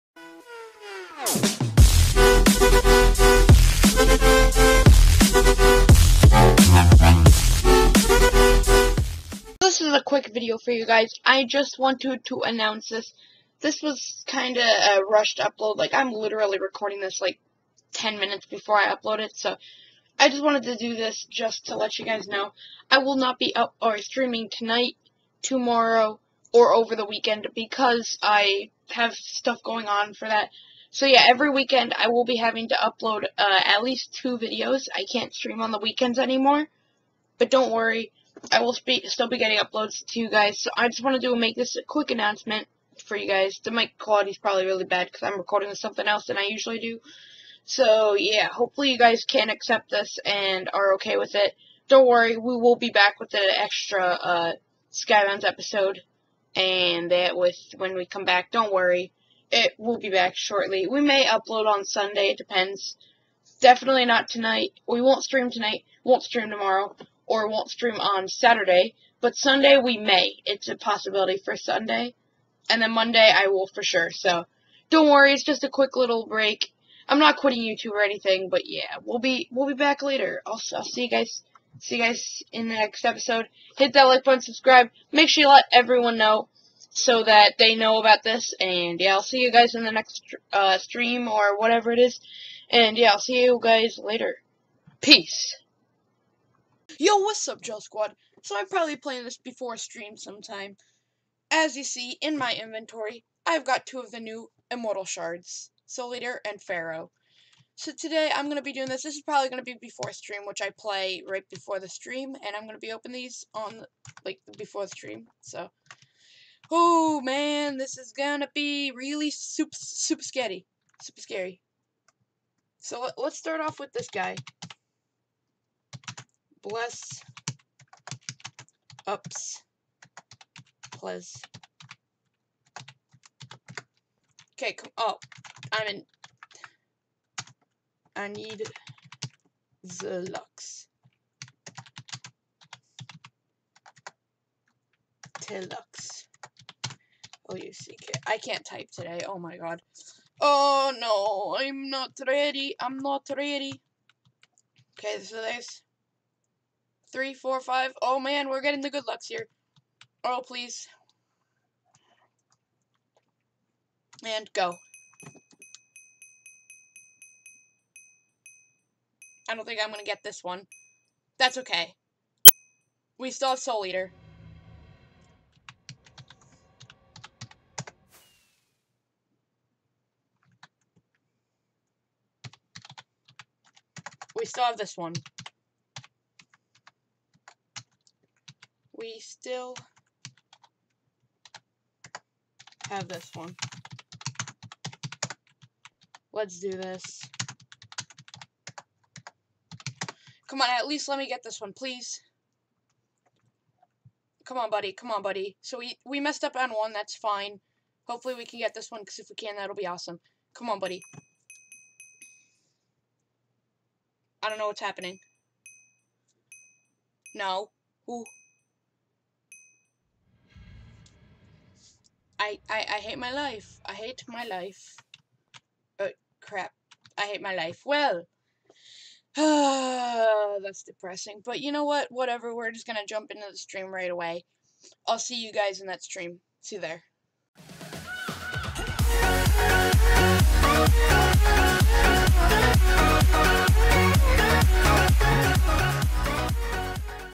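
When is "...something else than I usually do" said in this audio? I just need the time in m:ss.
0:45.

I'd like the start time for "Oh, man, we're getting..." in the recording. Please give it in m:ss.
2:38.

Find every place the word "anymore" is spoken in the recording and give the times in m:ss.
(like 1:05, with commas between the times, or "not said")
0:36.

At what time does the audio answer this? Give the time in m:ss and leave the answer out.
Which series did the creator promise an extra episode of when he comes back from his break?
0:54.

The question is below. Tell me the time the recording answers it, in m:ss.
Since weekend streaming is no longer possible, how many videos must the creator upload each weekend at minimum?
0:33.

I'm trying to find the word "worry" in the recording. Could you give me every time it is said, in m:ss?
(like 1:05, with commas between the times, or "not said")
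0:37, 0:52, 0:58, 1:15.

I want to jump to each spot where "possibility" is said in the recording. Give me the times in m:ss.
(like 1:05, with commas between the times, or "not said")
1:10.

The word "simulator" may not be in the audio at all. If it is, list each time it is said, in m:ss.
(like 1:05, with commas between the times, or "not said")
not said.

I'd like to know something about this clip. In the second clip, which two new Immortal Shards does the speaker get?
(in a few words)
Soul Eater and Pharaoh.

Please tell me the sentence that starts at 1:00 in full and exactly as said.
We may upload on Sunday, it depends.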